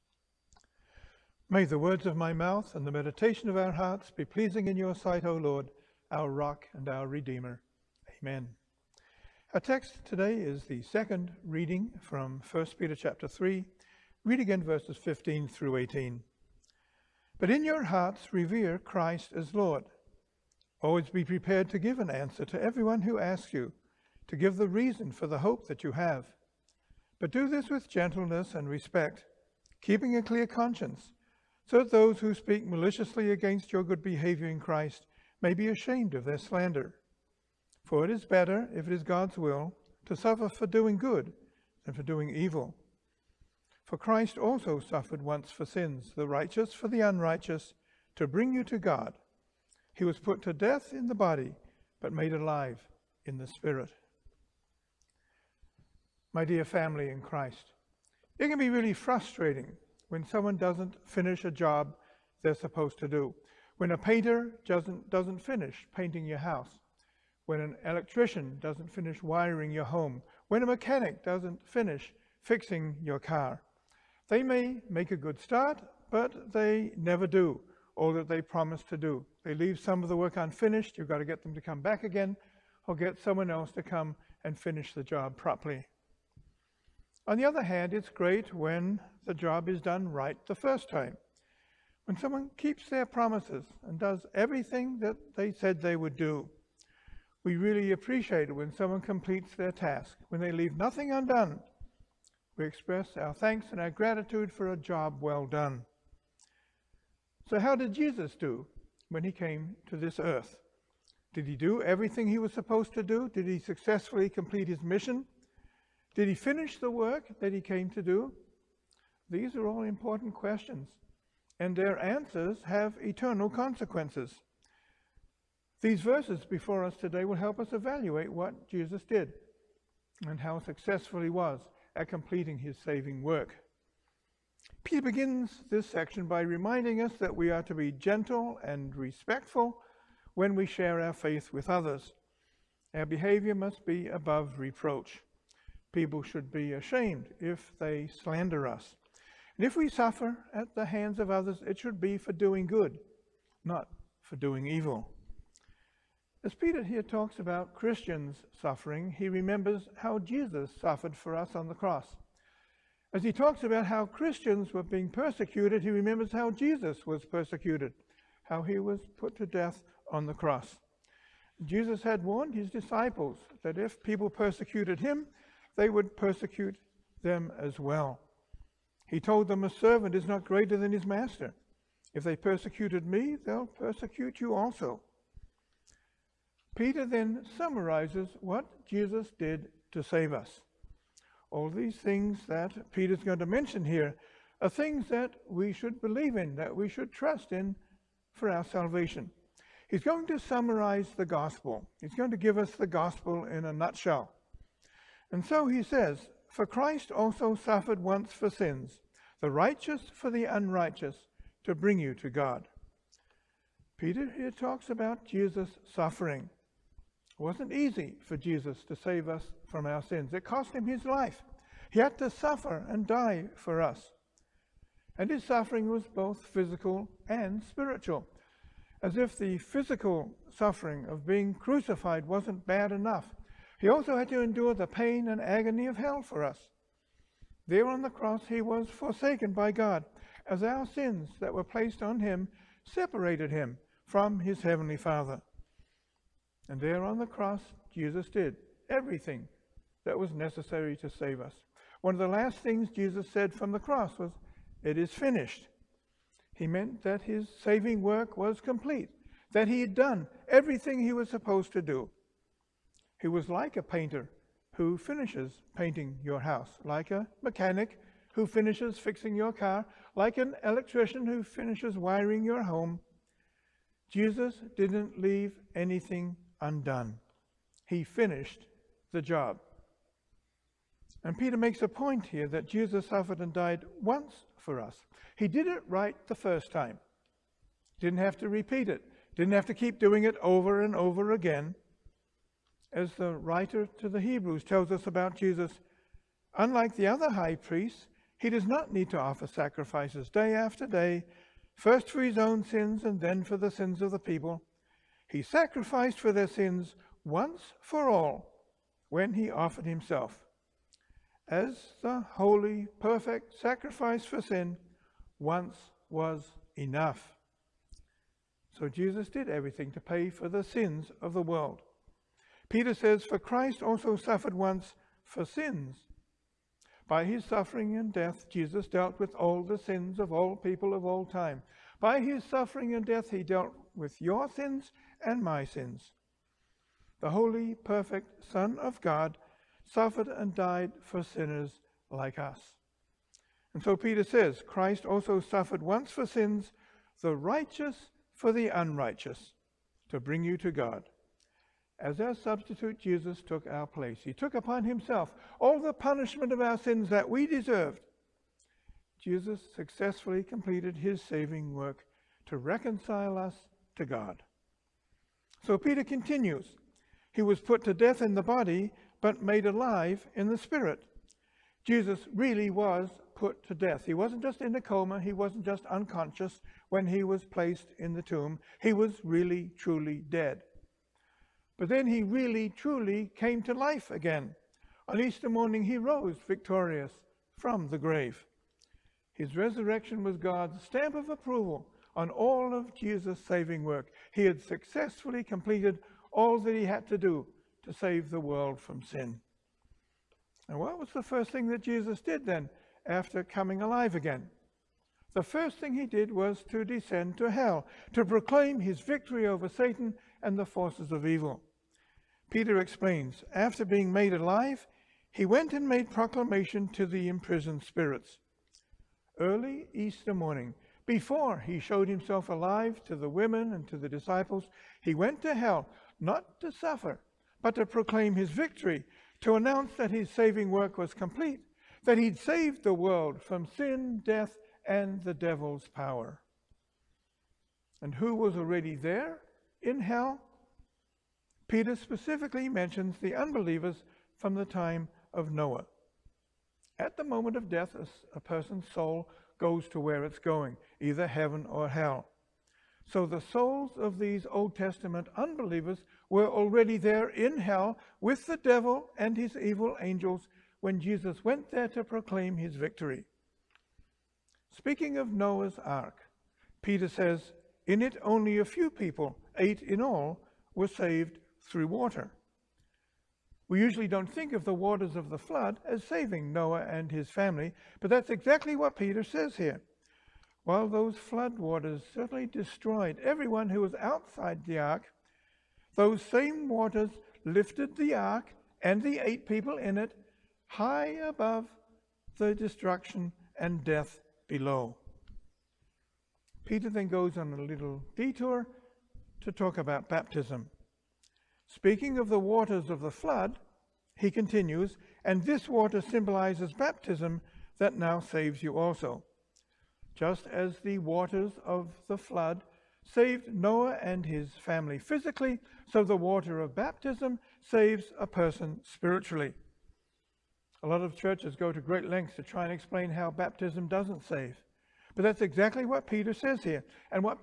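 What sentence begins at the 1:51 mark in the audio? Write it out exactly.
Did he do everything he was supposed to do?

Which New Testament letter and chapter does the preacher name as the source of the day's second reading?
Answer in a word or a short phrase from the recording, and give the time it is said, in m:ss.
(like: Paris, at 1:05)
1 Peter 3, at 0:12.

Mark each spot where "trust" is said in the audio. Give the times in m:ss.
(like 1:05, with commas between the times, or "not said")
3:17.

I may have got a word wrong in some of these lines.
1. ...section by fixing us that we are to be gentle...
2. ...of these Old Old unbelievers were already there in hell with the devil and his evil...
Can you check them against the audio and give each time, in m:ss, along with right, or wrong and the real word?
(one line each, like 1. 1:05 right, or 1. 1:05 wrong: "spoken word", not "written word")
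1. 2:15 wrong: "reminding", not "fixing"
2. 7:33 wrong: "Testament", not "Old".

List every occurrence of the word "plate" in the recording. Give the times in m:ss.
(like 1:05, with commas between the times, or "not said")
not said.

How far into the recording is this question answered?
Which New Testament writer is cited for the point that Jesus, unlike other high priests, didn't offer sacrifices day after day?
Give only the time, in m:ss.
4:53.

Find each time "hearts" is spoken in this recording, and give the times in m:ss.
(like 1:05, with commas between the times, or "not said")
0:03, 0:17.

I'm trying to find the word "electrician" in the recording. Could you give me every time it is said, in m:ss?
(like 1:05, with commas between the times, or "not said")
1:07, 4:30.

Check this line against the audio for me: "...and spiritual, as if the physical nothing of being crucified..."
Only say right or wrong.
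wrong.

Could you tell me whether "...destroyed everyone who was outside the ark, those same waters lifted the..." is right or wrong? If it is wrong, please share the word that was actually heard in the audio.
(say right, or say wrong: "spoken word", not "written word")
right.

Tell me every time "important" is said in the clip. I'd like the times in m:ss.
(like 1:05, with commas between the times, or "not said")
1:59.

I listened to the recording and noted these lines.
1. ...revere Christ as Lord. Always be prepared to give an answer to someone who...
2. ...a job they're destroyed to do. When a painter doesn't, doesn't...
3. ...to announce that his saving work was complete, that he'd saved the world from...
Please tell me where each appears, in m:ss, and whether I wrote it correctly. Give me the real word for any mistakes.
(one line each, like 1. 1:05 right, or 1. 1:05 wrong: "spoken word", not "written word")
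1. 0:18 wrong: "everyone", not "someone"
2. 1:01 wrong: "supposed", not "destroyed"
3. 7:09 right.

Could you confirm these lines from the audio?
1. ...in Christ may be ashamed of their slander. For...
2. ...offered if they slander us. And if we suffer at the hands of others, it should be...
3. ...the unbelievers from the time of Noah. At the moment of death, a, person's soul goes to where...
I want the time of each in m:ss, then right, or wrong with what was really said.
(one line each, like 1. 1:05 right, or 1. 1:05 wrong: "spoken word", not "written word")
1. 0:34 right
2. 2:26 wrong: "ashamed", not "offered"
3. 7:23 right.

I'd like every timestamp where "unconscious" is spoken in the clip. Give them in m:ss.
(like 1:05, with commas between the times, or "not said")
6:15.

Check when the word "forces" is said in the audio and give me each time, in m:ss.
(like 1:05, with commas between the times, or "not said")
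6:50.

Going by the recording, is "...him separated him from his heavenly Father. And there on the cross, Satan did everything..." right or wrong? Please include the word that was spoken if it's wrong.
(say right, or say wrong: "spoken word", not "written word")
wrong: "Jesus", not "Satan".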